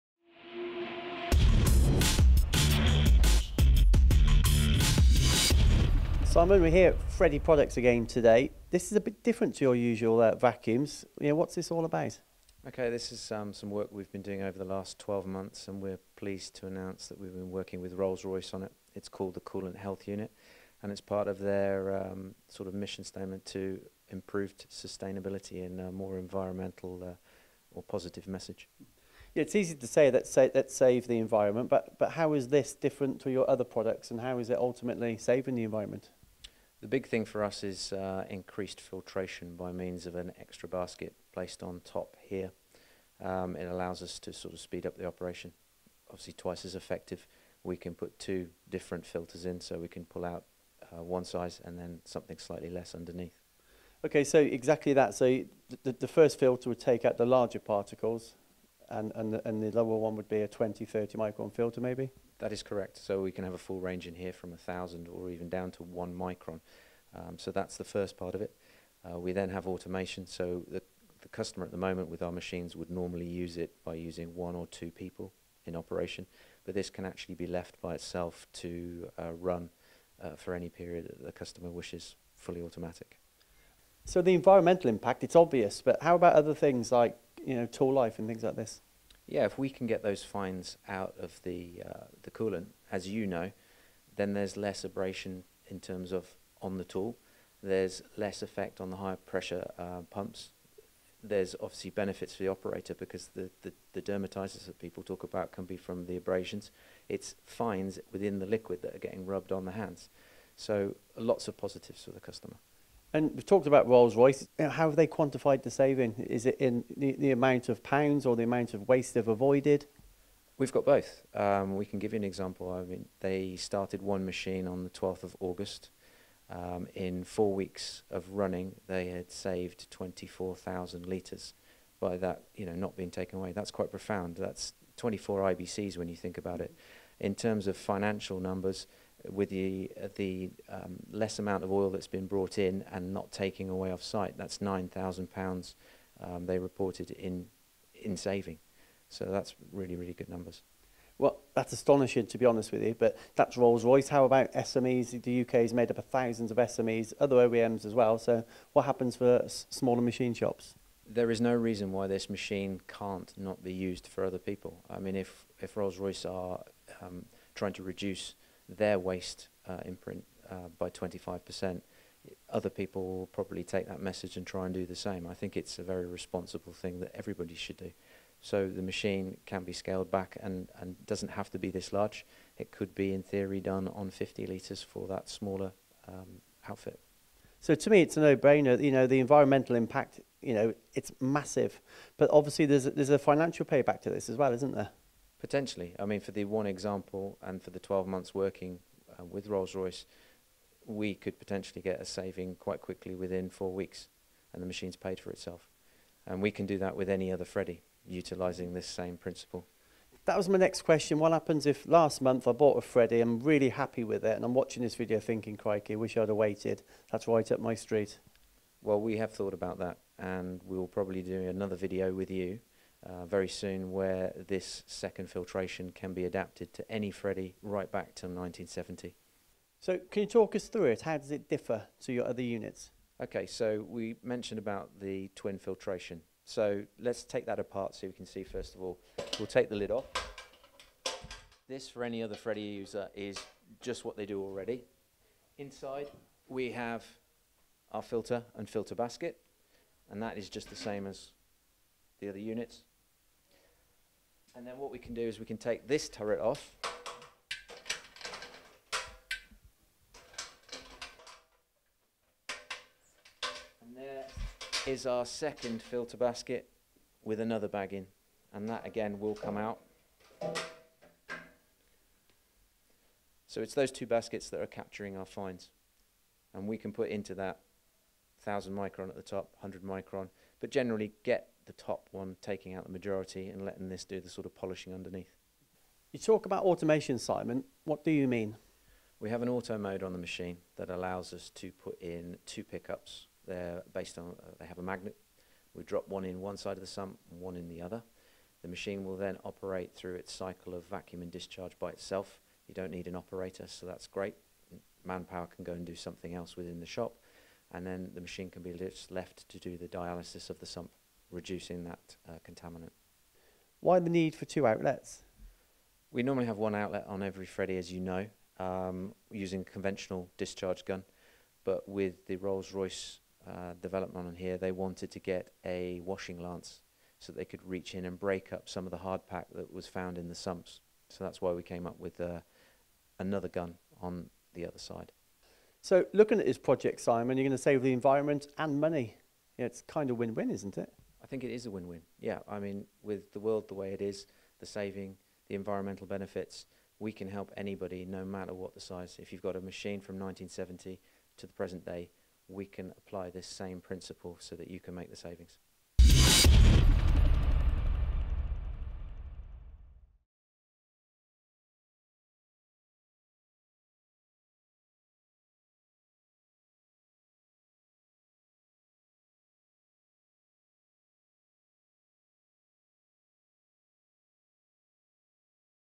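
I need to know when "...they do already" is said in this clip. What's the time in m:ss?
4:04.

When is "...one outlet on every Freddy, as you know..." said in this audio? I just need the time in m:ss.
5:16.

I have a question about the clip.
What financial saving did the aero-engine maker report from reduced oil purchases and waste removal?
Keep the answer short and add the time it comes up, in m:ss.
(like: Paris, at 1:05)
£9,000, at 2:24.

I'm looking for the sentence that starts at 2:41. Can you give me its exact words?
There is no reason why this machine can't not be used for other people.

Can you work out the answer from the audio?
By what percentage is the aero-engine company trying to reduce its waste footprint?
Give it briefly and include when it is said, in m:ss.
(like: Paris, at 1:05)
25%, at 2:50.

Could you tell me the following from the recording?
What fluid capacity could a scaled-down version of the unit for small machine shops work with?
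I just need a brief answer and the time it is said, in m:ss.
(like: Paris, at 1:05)
50 litres, at 3:04.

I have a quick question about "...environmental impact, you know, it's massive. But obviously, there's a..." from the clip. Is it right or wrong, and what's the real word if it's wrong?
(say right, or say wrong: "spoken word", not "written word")
right.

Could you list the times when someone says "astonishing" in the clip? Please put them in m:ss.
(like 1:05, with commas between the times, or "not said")
2:31.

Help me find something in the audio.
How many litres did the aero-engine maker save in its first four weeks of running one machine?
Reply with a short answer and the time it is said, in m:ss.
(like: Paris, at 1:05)
24,000, at 2:09.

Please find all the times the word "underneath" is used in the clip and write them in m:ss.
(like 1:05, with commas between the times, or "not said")
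0:52, 4:44.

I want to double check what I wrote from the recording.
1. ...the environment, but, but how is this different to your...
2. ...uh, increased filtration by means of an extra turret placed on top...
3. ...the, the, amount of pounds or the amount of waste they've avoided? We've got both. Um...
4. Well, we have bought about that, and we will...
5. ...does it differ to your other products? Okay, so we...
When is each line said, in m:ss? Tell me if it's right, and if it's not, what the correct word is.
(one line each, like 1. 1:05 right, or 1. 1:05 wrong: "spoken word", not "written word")
1. 0:31 right
2. 0:37 wrong: "basket", not "turret"
3. 1:56 right
4. 3:38 wrong: "thought", not "bought"
5. 3:51 wrong: "units", not "products".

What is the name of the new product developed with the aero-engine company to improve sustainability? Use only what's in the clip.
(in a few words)
Coolant Health Unit.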